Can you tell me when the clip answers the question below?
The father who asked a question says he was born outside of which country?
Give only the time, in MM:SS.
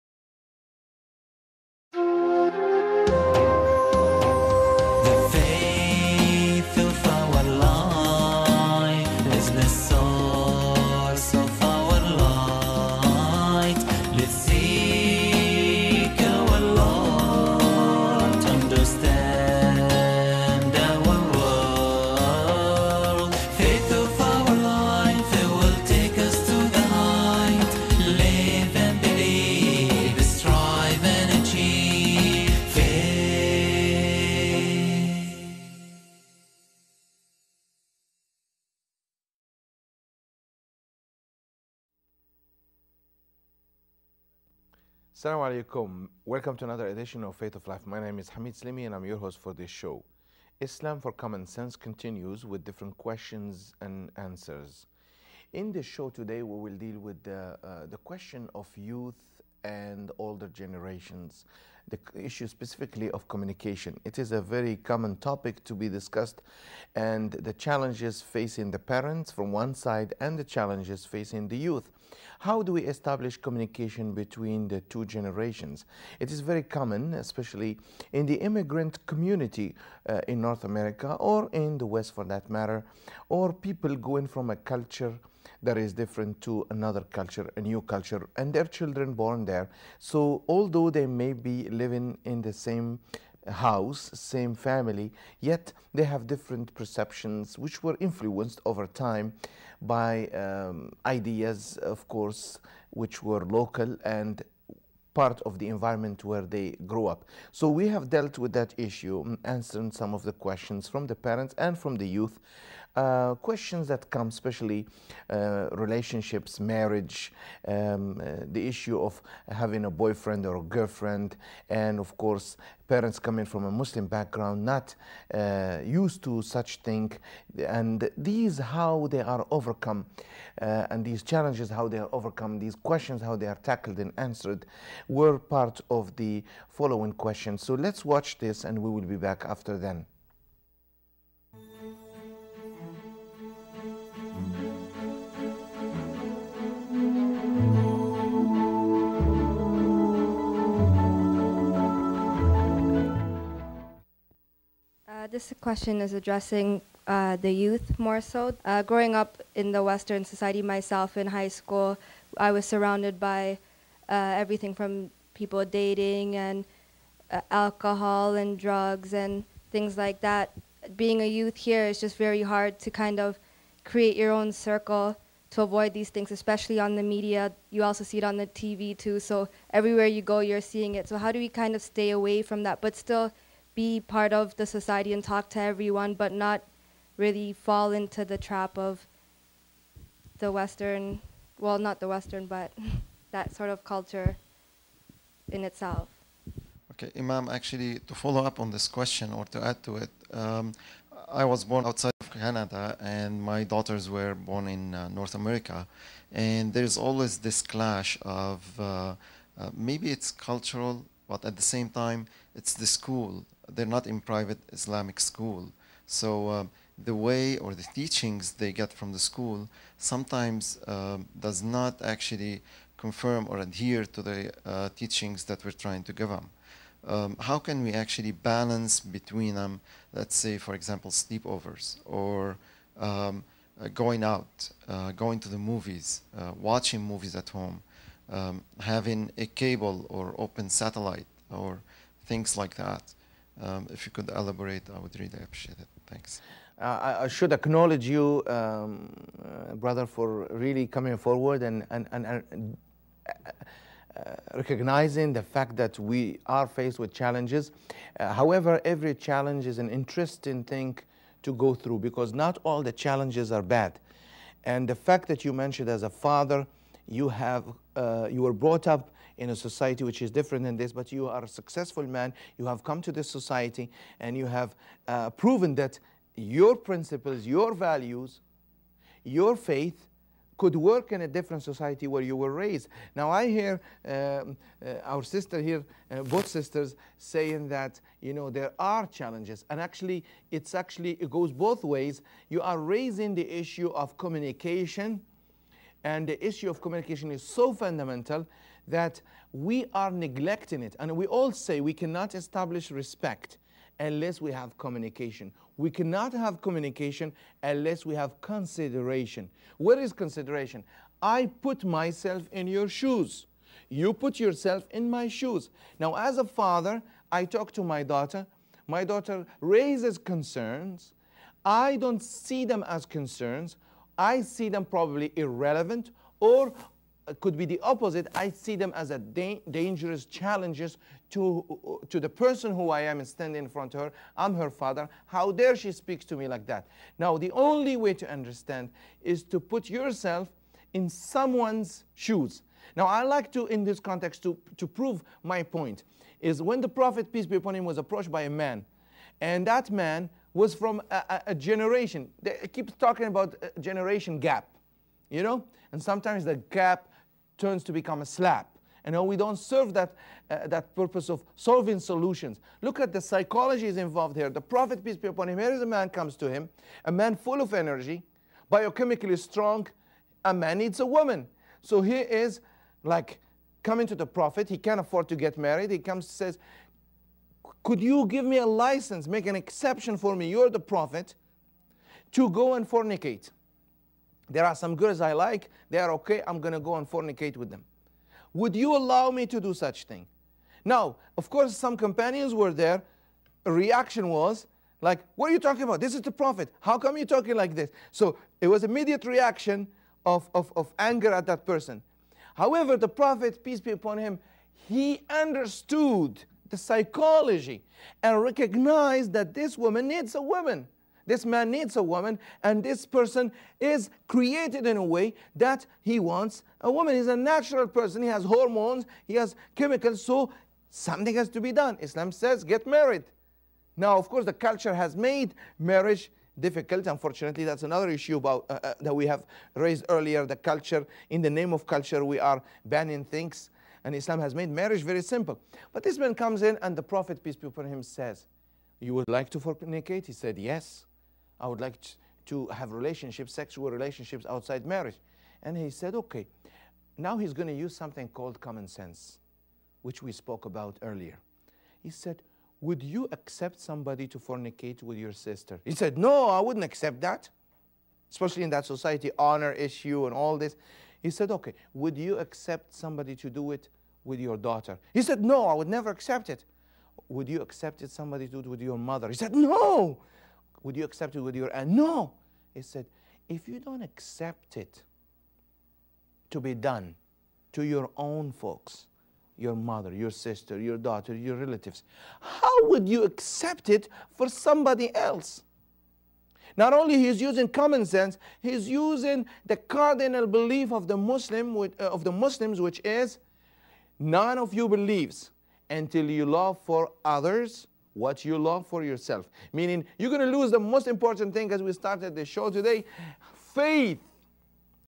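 03:22.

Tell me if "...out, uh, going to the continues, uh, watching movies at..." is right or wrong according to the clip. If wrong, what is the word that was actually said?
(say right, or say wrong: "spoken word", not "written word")
wrong: "movies", not "continues".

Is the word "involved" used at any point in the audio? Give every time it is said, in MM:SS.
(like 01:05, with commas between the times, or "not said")
06:03.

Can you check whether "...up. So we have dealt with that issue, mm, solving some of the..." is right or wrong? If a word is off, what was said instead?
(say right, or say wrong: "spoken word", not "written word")
wrong: "answering", not "solving".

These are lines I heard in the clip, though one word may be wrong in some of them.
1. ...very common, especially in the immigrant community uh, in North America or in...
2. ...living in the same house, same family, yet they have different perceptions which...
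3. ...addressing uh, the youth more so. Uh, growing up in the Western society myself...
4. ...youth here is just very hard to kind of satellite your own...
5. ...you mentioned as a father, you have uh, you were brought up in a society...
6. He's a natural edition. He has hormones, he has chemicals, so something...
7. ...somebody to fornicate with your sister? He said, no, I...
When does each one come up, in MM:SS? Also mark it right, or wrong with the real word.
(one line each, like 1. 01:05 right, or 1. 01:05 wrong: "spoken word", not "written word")
1. 01:16 right
2. 01:31 right
3. 02:36 right
4. 02:51 wrong: "create", not "satellite"
5. 04:25 right
6. 06:57 wrong: "person", not "edition"
7. 07:33 right.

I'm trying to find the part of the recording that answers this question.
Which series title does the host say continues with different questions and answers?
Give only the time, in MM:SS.
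00:50.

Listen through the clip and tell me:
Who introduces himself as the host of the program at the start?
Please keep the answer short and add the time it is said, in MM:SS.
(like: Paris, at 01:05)
Hamid Slimi, at 00:48.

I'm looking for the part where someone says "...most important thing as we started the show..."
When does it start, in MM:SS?
08:20.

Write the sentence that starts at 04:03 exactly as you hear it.
Um, if you could elaborate, I would really appreciate it.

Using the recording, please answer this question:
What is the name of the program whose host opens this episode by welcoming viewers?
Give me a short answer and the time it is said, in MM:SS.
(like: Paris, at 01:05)
Faith of Life, at 00:47.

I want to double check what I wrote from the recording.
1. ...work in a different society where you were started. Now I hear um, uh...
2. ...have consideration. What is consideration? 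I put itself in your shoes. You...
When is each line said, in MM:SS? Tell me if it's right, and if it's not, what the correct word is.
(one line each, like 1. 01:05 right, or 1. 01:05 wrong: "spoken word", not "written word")
1. 04:40 wrong: "raised", not "started"
2. 05:08 wrong: "myself", not "itself".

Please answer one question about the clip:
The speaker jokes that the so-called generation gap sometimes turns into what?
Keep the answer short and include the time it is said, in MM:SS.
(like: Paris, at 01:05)
a slap, at 05:58.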